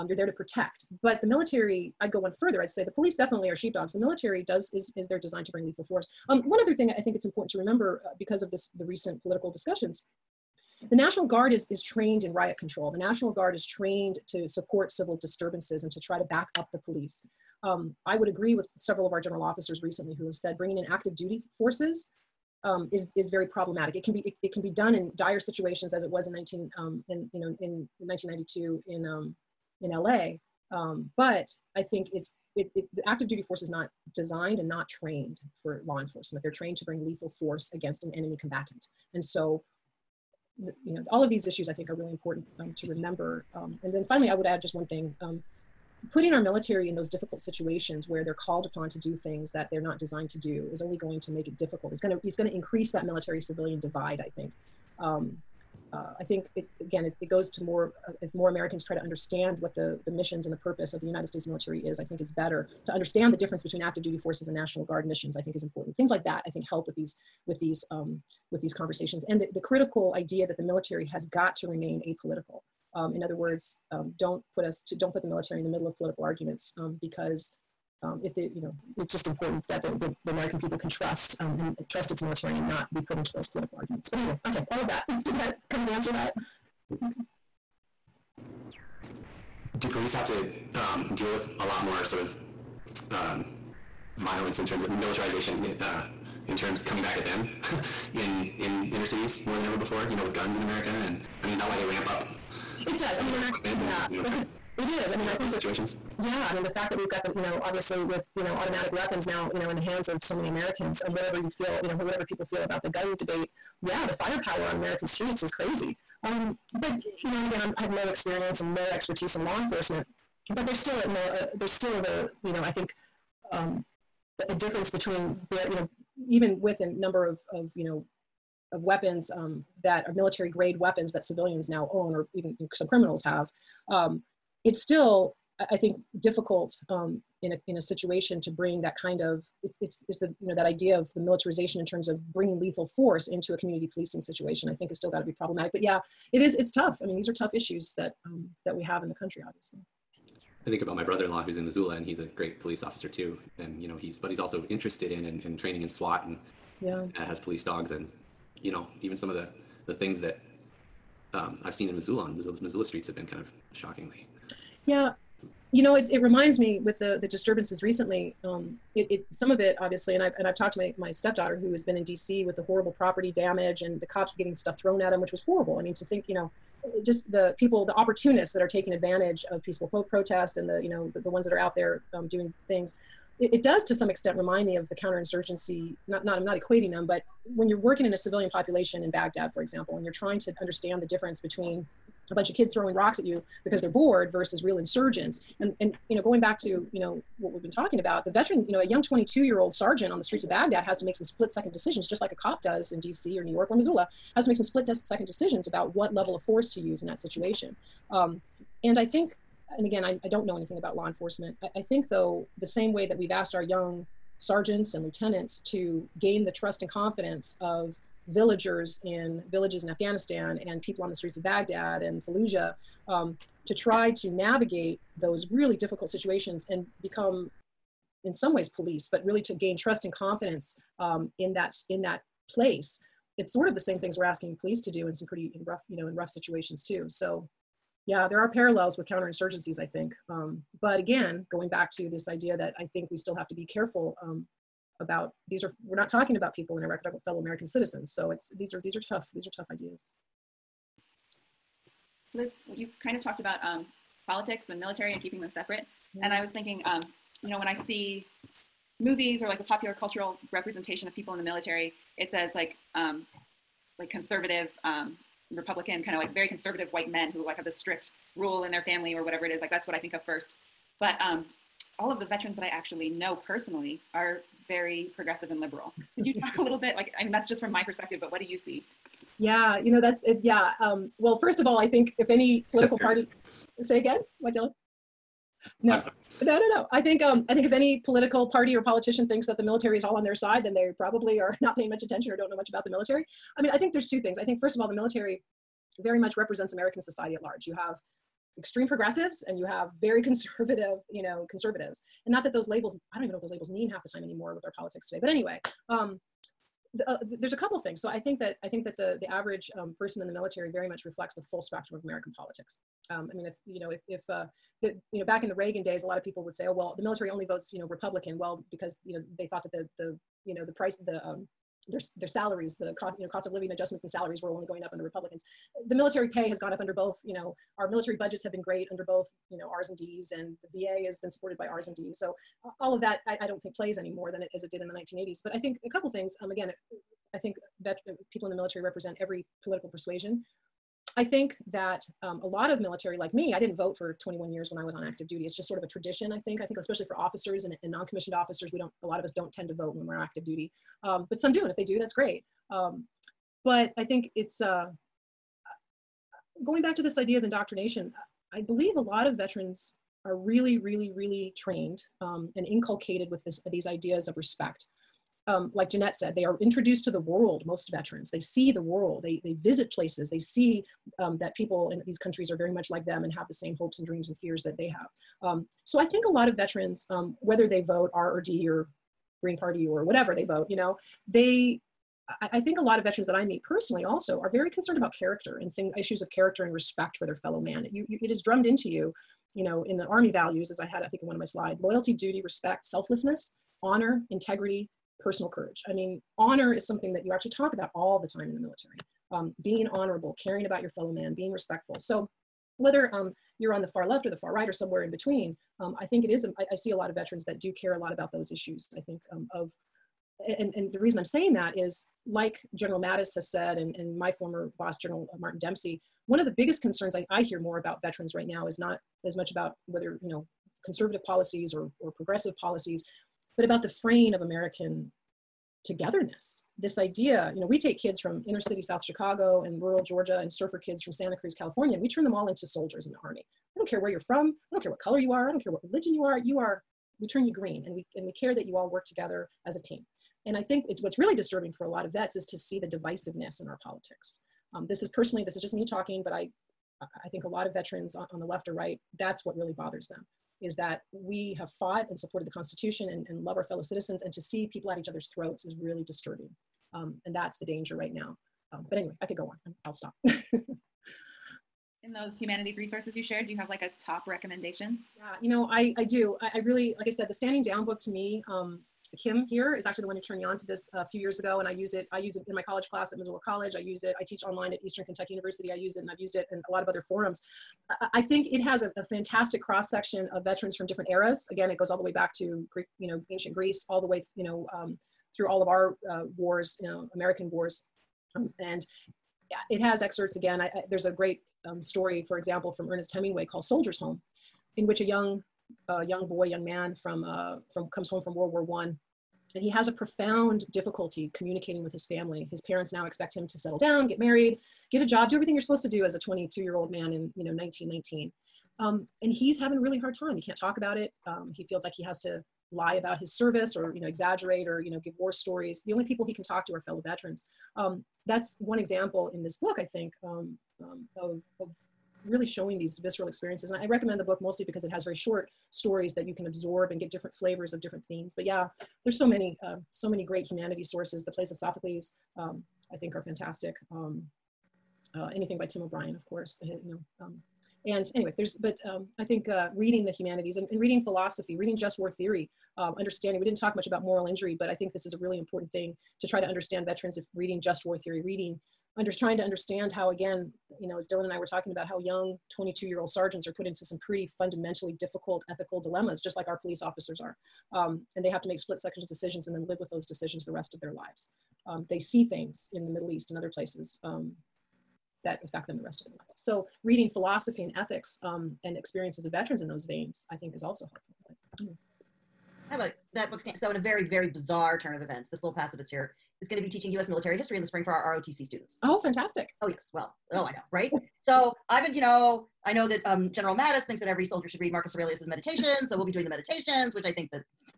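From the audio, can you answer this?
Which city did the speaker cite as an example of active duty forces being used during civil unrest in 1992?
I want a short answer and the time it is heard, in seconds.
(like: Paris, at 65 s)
LA, at 29 s.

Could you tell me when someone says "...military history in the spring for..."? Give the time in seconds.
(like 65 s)
577 s.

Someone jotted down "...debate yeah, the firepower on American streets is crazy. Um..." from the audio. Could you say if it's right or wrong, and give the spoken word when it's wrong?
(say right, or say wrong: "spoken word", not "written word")
right.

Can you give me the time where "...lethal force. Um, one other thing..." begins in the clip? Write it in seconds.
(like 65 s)
5 s.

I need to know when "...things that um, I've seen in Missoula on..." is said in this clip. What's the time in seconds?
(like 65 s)
159 s.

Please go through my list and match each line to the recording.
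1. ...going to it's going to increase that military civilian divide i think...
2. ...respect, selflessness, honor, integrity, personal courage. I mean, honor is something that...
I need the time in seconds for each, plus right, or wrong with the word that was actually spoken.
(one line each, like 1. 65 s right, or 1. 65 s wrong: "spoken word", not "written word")
1. 52 s right
2. 392 s right.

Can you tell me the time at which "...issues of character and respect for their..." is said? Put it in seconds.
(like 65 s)
385 s.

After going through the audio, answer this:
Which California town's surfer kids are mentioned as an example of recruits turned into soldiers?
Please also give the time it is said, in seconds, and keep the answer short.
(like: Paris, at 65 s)
Santa Cruz, at 431 s.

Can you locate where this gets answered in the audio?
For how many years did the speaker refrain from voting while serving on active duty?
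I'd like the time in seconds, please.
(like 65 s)
344 s.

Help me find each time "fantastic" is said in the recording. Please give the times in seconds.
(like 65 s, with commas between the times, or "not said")
479 s, 533 s, 578 s.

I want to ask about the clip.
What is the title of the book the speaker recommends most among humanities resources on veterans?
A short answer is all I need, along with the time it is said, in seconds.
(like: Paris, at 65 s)
Standing Down, at 467 s.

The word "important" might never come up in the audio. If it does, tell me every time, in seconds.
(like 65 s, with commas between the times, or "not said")
7 s, 42 s, 65 s, 79 s, 545 s.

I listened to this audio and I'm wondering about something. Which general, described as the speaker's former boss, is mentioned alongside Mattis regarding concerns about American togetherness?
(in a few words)
Martin Dempsey.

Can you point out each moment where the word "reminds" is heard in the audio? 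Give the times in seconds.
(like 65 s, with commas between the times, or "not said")
166 s, 184 s.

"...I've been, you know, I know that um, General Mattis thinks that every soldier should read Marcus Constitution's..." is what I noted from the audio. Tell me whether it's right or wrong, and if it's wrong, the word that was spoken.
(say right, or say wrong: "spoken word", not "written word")
wrong: "Aurelius", not "Constitution".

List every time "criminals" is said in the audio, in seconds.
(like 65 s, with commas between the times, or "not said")
132 s.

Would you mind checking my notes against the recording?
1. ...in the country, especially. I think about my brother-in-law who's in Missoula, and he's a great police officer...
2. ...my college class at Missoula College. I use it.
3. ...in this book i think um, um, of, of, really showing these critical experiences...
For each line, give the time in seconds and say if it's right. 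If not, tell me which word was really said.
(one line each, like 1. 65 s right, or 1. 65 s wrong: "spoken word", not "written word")
1. 149 s wrong: "obviously", not "especially"
2. 472 s right
3. 519 s wrong: "visceral", not "critical".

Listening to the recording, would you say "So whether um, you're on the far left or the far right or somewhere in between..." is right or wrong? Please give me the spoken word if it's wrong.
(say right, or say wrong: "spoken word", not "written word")
right.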